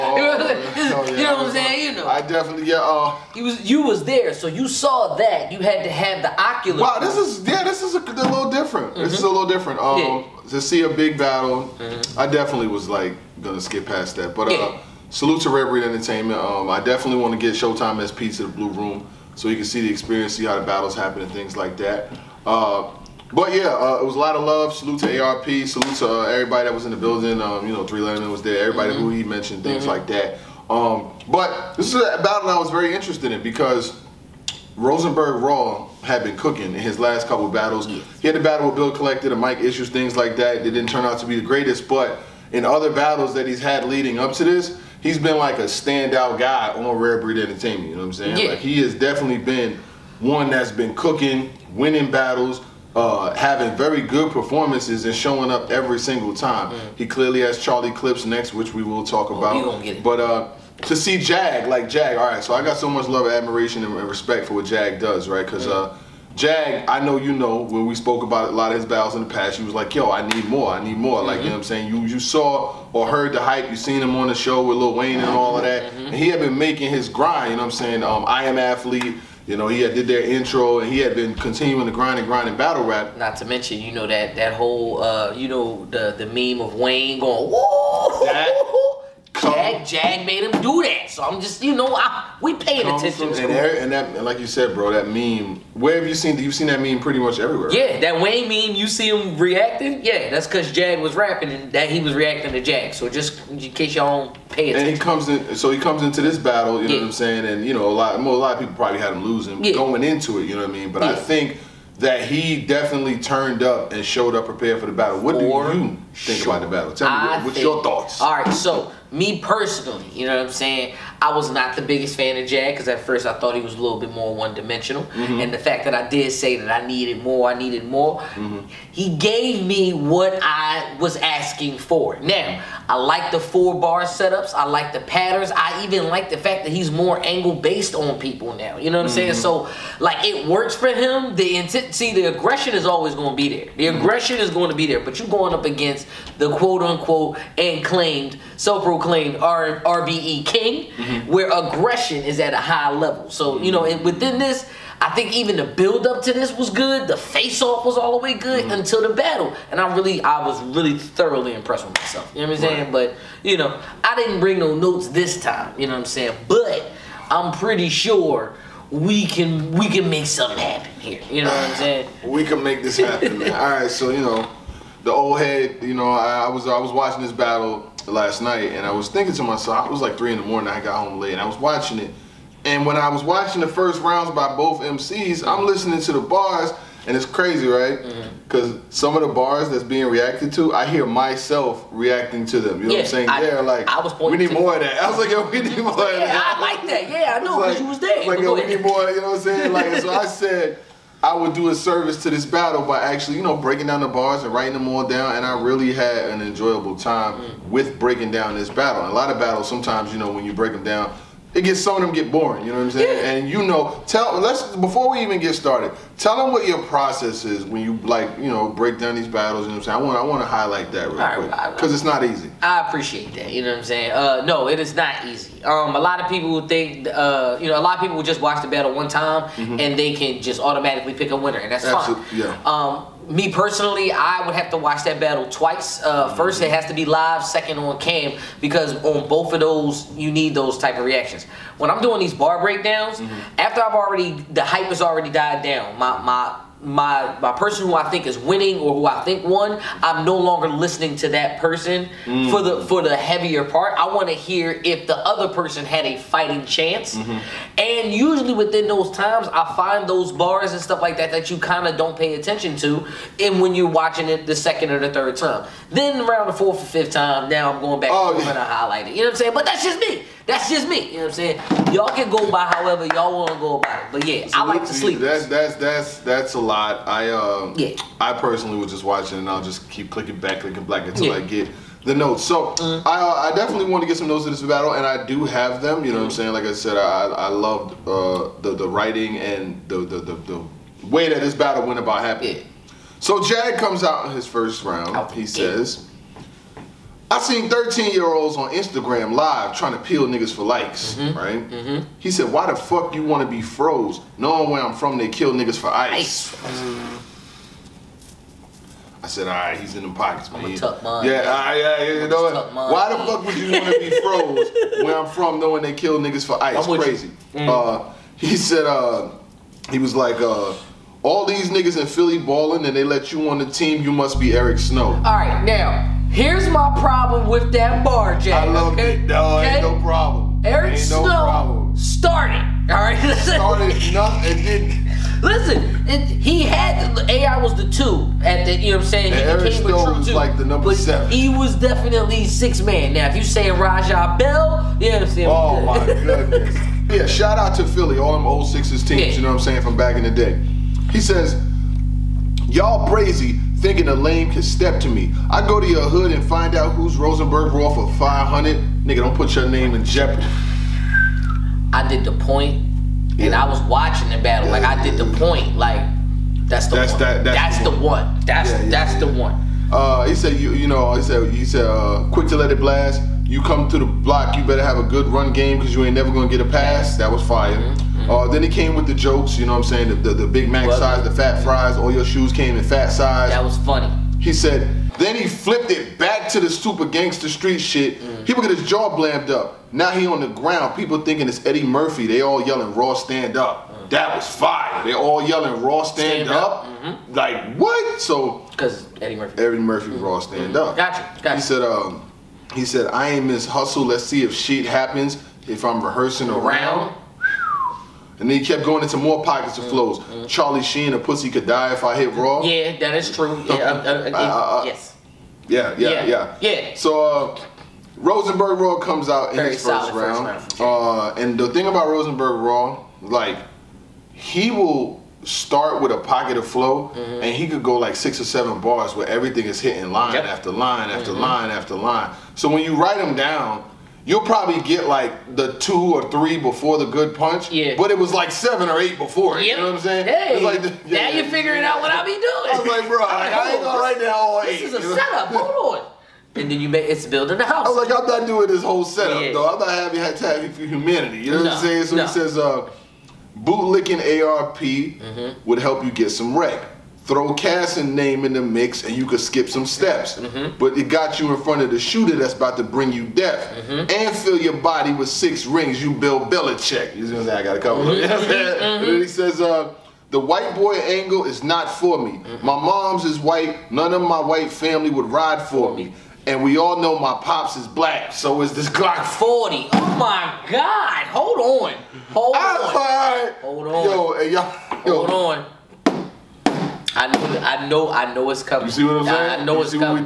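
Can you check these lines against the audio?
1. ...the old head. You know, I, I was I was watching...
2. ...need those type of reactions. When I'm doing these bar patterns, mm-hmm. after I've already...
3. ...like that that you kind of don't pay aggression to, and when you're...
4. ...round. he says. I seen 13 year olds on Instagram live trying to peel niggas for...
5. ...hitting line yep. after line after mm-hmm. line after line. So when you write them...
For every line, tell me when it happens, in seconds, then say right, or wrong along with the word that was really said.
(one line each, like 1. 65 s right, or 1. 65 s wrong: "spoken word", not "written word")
1. 175 s right
2. 240 s wrong: "breakdowns", not "patterns"
3. 261 s wrong: "attention", not "aggression"
4. 294 s right
5. 429 s right.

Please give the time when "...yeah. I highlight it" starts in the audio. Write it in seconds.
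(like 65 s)
268 s.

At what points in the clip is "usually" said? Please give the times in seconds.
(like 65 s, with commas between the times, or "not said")
258 s.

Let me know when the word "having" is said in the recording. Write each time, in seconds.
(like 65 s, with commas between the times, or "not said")
53 s, 449 s.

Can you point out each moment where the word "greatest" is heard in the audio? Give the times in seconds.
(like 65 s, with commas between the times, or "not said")
41 s.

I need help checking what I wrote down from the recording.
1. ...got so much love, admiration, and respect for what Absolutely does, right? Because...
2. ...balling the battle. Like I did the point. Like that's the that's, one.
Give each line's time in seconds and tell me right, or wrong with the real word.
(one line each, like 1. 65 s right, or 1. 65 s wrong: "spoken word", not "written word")
1. 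62 s wrong: "Jag", not "Absolutely"
2. 363 s wrong: "watching", not "balling".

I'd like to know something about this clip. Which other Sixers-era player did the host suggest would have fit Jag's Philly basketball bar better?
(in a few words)
Raja Bell.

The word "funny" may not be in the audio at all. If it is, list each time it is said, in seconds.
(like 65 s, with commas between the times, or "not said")
383 s.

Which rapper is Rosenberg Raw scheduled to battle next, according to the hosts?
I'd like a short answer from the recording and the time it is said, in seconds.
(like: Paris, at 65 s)
Charlie Clips, at 57 s.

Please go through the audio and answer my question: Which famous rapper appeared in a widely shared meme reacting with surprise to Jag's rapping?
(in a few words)
Lil Wayne.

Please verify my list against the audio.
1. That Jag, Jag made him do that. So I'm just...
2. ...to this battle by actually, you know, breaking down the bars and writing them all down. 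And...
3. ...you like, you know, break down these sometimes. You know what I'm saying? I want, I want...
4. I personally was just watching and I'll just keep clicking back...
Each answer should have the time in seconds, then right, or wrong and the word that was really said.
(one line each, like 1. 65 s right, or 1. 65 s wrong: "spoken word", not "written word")
1. 88 s right
2. 202 s right
3. 217 s wrong: "battles", not "sometimes"
4. 278 s right.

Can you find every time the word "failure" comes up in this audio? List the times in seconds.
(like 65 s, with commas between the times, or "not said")
not said.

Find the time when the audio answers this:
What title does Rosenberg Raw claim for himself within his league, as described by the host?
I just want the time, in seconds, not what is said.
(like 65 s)
149 s.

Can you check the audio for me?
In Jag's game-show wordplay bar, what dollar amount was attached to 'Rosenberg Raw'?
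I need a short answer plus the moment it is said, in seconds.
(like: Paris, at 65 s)
500, at 358 s.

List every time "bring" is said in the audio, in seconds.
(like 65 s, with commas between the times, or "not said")
164 s, 462 s.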